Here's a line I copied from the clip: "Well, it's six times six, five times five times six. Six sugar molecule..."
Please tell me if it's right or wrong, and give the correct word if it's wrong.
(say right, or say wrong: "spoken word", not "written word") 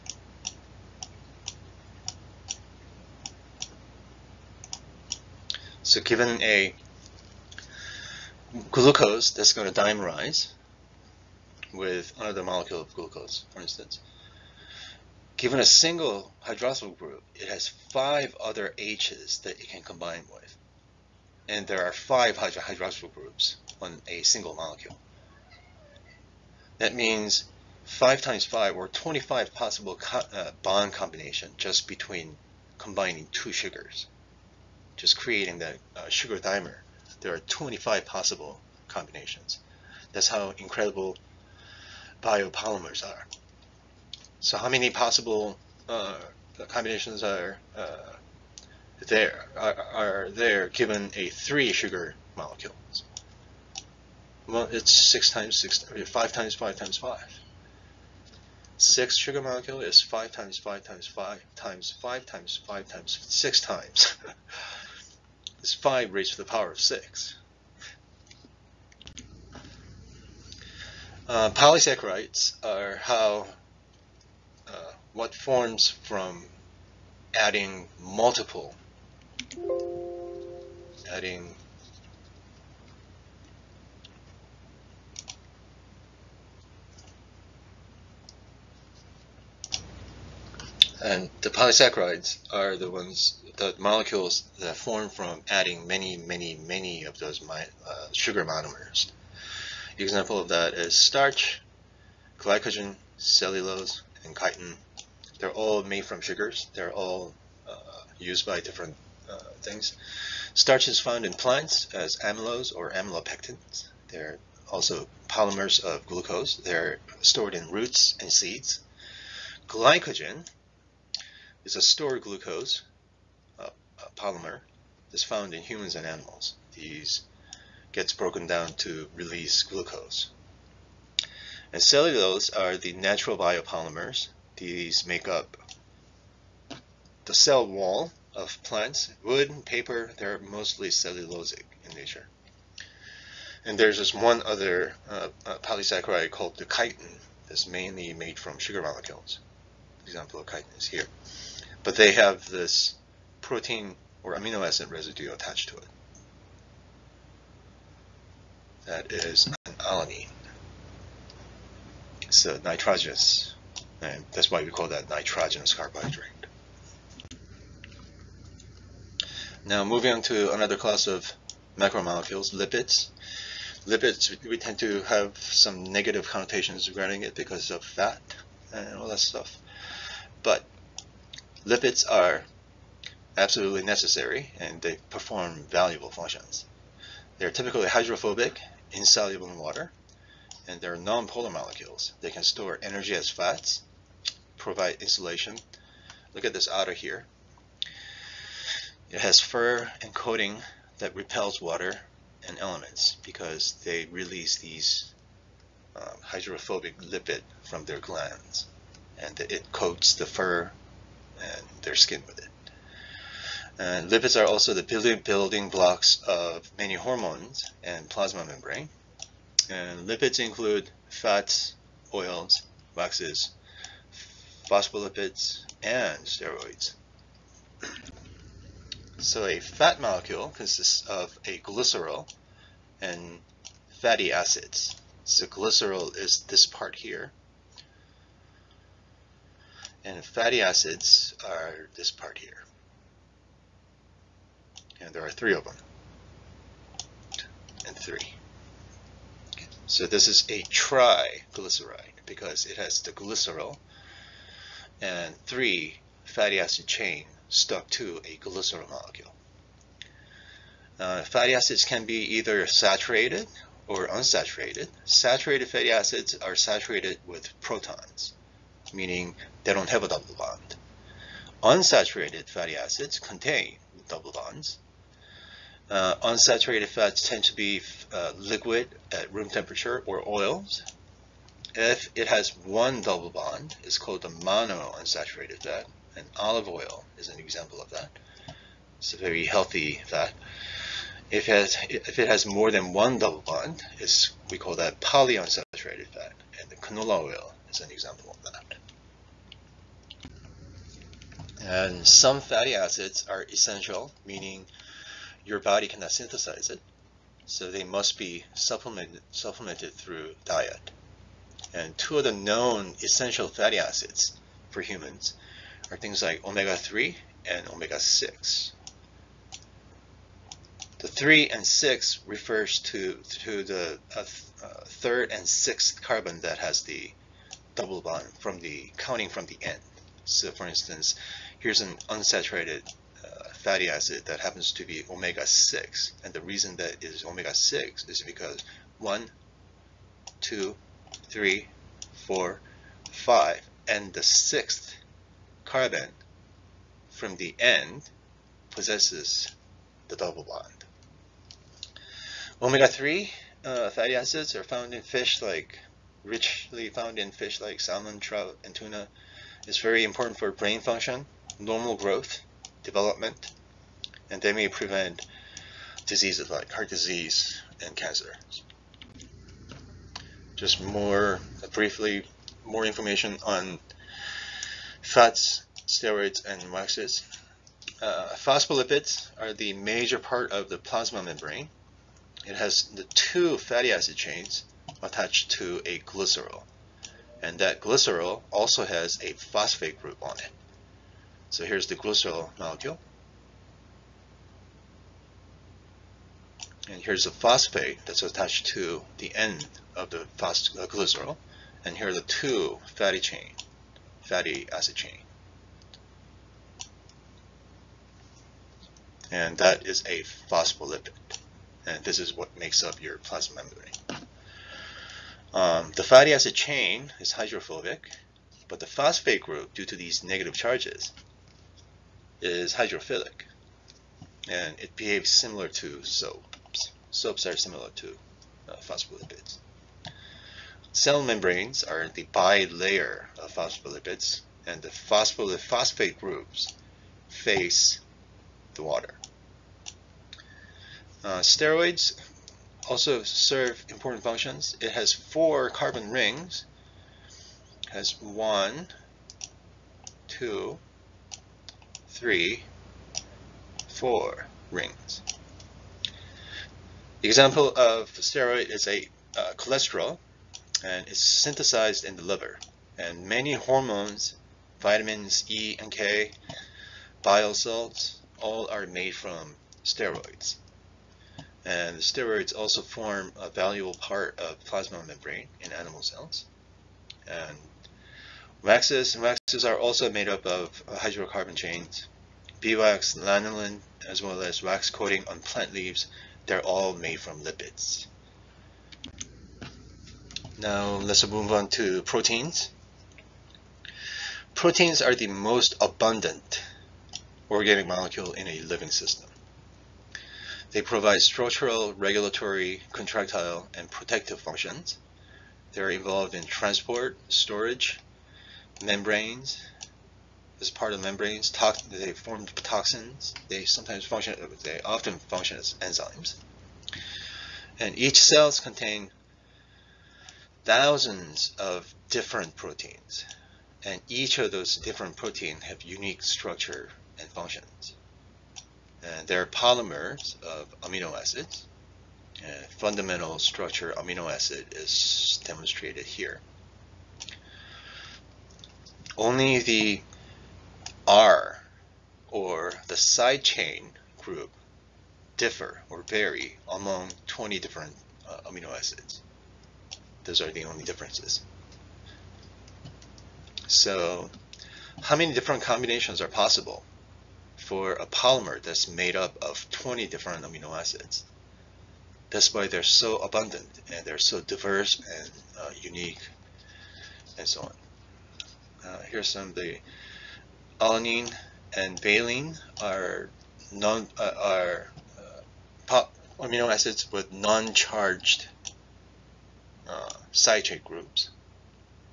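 wrong: "five", not "six".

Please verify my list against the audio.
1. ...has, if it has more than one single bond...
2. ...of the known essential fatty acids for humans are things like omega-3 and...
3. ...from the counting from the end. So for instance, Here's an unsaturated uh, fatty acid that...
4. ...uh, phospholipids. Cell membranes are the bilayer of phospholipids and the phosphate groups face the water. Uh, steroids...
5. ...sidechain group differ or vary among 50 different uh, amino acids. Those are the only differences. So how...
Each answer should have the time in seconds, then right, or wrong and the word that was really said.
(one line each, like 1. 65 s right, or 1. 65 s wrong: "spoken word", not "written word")
1. 291 s wrong: "double", not "single"
2. 312 s right
3. 328 s right
4. 428 s right
5. 542 s wrong: "20", not "50".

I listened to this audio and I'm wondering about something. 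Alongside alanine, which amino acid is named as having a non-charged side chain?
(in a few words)
valine.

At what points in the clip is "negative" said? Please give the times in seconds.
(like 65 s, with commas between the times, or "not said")
175 s, 420 s.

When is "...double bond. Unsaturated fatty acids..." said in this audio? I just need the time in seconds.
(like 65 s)
270 s.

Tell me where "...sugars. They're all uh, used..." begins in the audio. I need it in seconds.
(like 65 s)
106 s.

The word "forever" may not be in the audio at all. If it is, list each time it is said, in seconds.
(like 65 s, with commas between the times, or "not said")
not said.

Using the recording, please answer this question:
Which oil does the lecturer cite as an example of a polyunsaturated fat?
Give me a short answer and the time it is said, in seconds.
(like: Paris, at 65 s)
canola oil, at 296 s.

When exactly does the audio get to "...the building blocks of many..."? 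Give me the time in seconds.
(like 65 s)
214 s.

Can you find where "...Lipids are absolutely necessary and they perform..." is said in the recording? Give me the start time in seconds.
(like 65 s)
181 s.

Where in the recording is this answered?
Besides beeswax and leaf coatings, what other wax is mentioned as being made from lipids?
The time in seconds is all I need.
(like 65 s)
483 s.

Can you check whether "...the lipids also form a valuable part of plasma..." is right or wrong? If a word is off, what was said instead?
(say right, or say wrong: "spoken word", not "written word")
wrong: "steroids", not "lipids".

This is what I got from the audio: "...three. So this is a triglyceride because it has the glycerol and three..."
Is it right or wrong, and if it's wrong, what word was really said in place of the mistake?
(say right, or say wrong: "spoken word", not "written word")
right.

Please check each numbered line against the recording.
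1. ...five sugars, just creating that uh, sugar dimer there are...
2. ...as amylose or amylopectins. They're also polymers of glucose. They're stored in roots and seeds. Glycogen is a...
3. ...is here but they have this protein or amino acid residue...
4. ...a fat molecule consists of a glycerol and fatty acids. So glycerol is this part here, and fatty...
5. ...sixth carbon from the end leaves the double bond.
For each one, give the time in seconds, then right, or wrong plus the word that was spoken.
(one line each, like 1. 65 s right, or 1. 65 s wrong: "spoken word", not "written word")
1. 33 s wrong: "two", not "five"
2. 111 s right
3. 150 s right
4. 229 s right
5. 344 s wrong: "possesses", not "leaves".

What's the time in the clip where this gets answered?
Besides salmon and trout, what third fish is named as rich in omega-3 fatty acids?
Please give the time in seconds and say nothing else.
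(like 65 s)
358 s.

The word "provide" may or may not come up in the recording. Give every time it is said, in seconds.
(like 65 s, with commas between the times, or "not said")
194 s, 500 s.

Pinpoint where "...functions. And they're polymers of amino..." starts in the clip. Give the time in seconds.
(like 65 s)
527 s.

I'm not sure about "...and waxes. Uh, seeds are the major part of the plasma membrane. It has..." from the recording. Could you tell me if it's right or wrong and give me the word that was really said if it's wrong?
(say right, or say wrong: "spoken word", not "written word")
wrong: "phospholipids", not "seeds".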